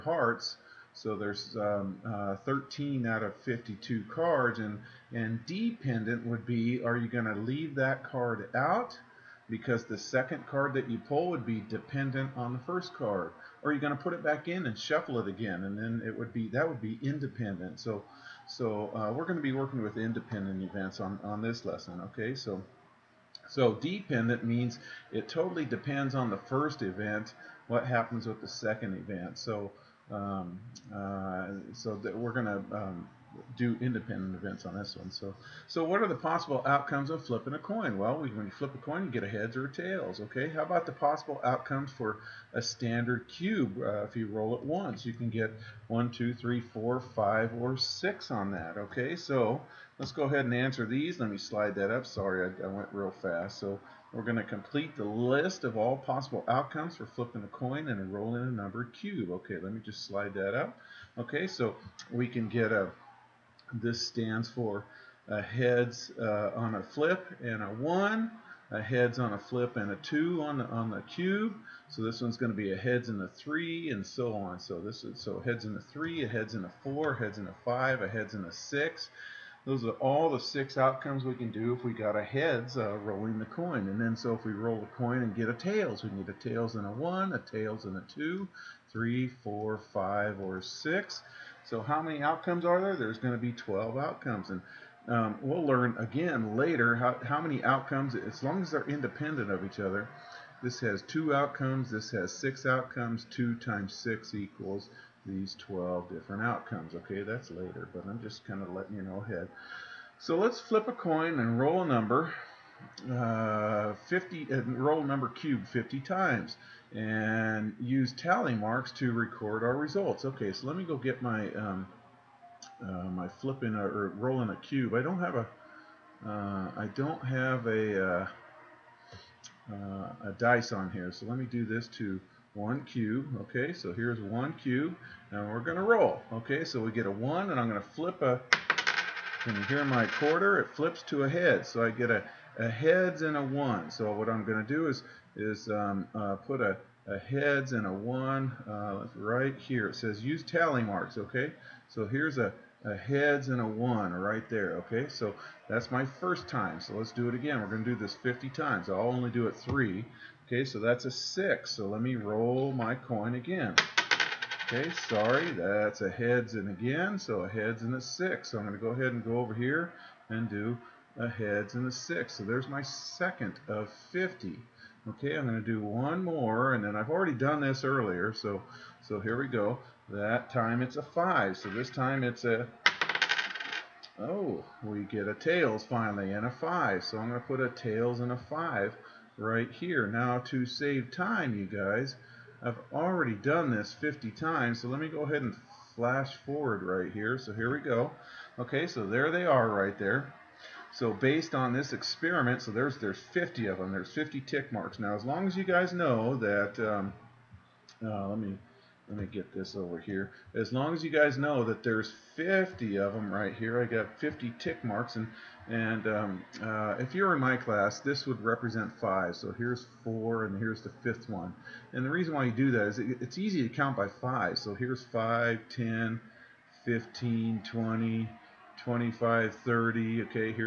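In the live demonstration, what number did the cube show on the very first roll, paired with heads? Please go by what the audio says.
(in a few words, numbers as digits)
1.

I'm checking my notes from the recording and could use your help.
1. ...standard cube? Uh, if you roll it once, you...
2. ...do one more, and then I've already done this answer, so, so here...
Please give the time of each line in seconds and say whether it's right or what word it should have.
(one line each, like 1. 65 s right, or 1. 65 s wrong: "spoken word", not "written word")
1. 42 s right
2. 175 s wrong: "earlier", not "answer".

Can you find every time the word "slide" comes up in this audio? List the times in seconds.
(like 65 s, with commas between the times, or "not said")
51 s, 60 s.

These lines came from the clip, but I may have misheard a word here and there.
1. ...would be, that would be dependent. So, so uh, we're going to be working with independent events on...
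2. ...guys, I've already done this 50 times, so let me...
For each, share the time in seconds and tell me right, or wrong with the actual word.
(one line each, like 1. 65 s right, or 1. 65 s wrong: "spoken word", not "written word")
1. 16 s wrong: "independent", not "dependent"
2. 191 s right.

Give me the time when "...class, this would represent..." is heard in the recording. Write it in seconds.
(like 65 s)
217 s.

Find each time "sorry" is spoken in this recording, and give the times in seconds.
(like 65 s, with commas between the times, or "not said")
52 s, 165 s.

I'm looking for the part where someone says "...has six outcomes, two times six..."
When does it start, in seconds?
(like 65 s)
102 s.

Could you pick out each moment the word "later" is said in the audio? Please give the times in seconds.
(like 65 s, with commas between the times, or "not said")
96 s, 107 s.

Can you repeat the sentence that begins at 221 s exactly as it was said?
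And the reason why you do that is it, it's easy to count by five.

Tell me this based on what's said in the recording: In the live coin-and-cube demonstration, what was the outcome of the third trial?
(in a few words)
tails and 5.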